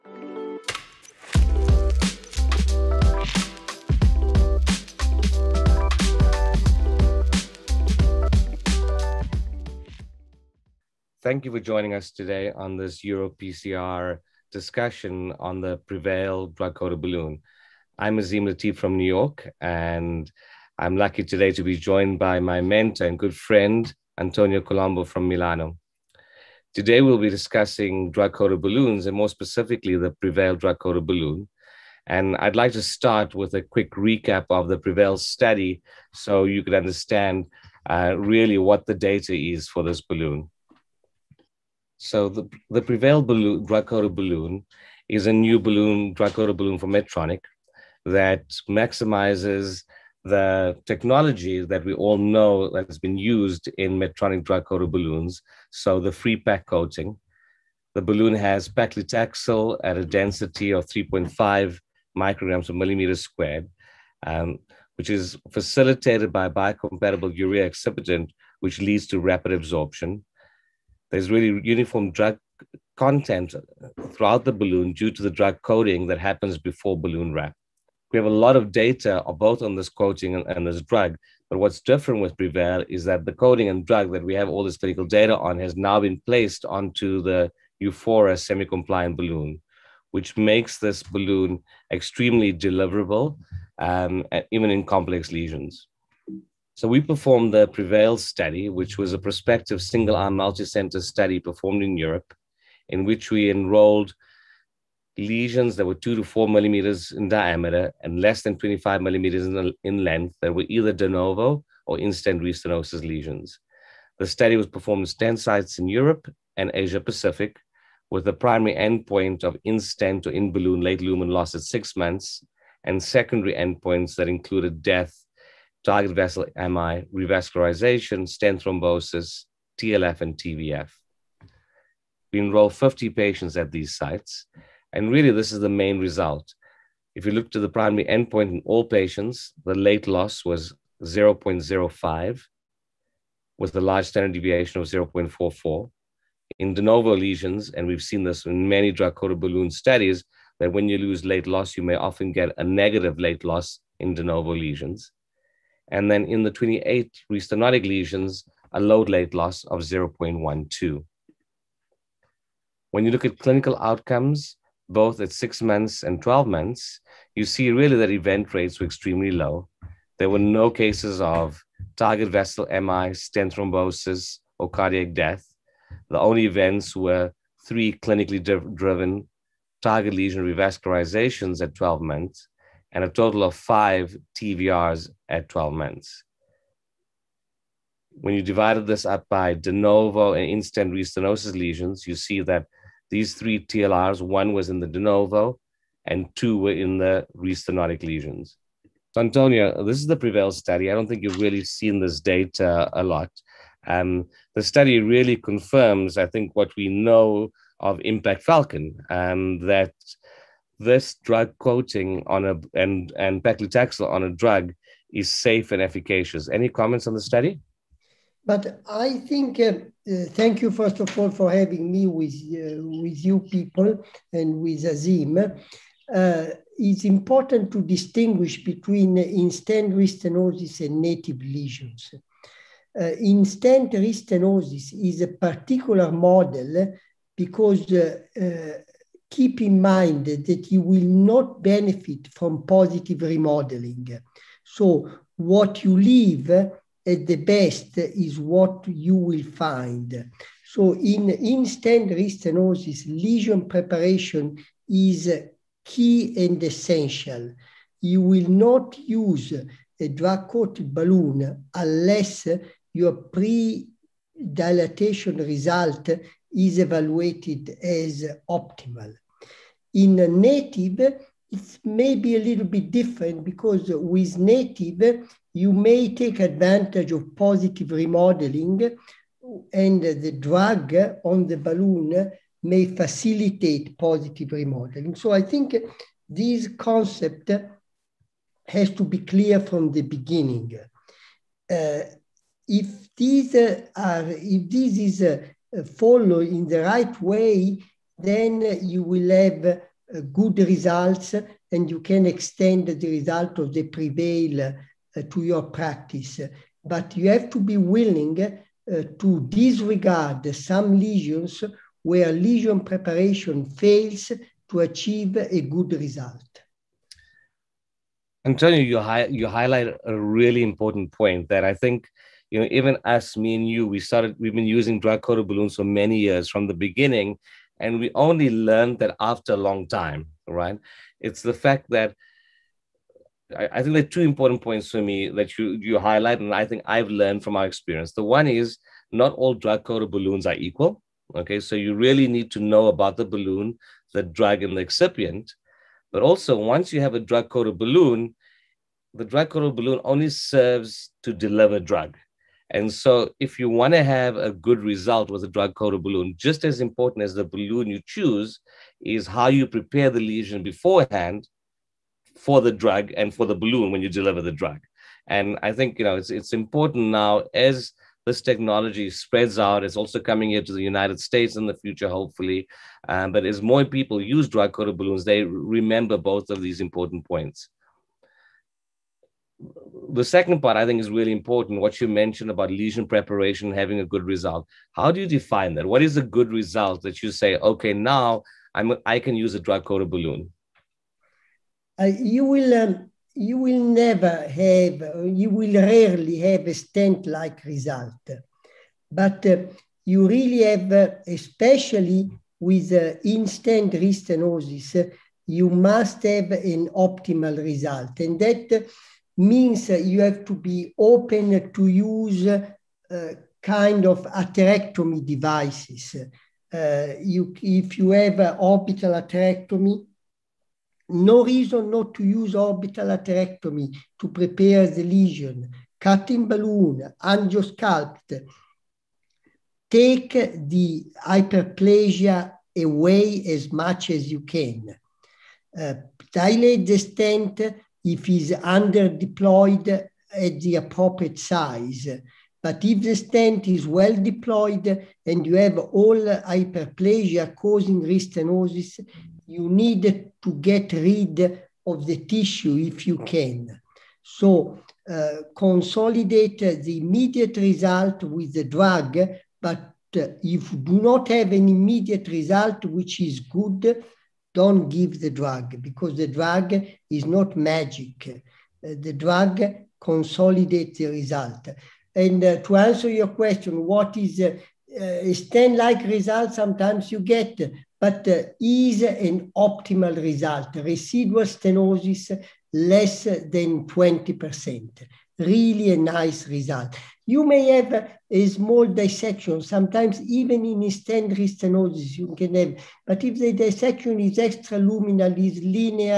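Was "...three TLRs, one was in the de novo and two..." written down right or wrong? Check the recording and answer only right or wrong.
right.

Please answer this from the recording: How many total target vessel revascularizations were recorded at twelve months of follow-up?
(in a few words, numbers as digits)
5.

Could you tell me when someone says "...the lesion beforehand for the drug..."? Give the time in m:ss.
6:00.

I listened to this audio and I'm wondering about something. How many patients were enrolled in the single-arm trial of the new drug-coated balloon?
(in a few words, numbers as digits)
50.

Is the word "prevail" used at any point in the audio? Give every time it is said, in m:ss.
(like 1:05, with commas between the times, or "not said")
0:15, 0:30, 0:34, 0:42, 1:22, 1:37, 3:20, 5:03.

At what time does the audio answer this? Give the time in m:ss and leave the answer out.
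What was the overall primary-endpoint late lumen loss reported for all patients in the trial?
2:21.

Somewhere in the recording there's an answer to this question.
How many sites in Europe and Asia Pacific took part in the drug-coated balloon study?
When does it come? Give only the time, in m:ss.
1:55.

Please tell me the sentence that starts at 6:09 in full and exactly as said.
It's also coming here to the United States in the future, hopefully.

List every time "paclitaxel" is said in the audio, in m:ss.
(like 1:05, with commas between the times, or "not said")
0:58, 3:33.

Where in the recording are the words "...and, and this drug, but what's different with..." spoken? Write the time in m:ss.
1:20.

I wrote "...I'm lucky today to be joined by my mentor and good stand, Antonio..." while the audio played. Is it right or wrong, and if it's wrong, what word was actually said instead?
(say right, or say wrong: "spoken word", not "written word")
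wrong: "friend", not "stand".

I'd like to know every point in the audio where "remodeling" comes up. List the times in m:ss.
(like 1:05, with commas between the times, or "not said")
4:03, 4:37, 4:44.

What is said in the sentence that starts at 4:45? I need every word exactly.
So I think this concept has to be clear from the beginning.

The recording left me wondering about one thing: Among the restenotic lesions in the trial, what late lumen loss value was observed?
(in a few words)
0.12.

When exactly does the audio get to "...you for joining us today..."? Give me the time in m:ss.
0:11.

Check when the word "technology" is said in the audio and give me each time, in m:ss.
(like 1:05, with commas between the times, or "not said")
0:50, 6:08.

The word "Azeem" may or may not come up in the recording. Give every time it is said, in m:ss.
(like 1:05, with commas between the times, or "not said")
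0:18, 3:44.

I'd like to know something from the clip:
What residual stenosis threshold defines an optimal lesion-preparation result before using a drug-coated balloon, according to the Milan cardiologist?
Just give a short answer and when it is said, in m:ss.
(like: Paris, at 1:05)
Less than 20%, at 8:02.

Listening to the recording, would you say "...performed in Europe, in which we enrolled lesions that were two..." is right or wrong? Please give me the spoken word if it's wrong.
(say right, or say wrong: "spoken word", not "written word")
right.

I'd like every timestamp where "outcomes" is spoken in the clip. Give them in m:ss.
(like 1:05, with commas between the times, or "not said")
2:43.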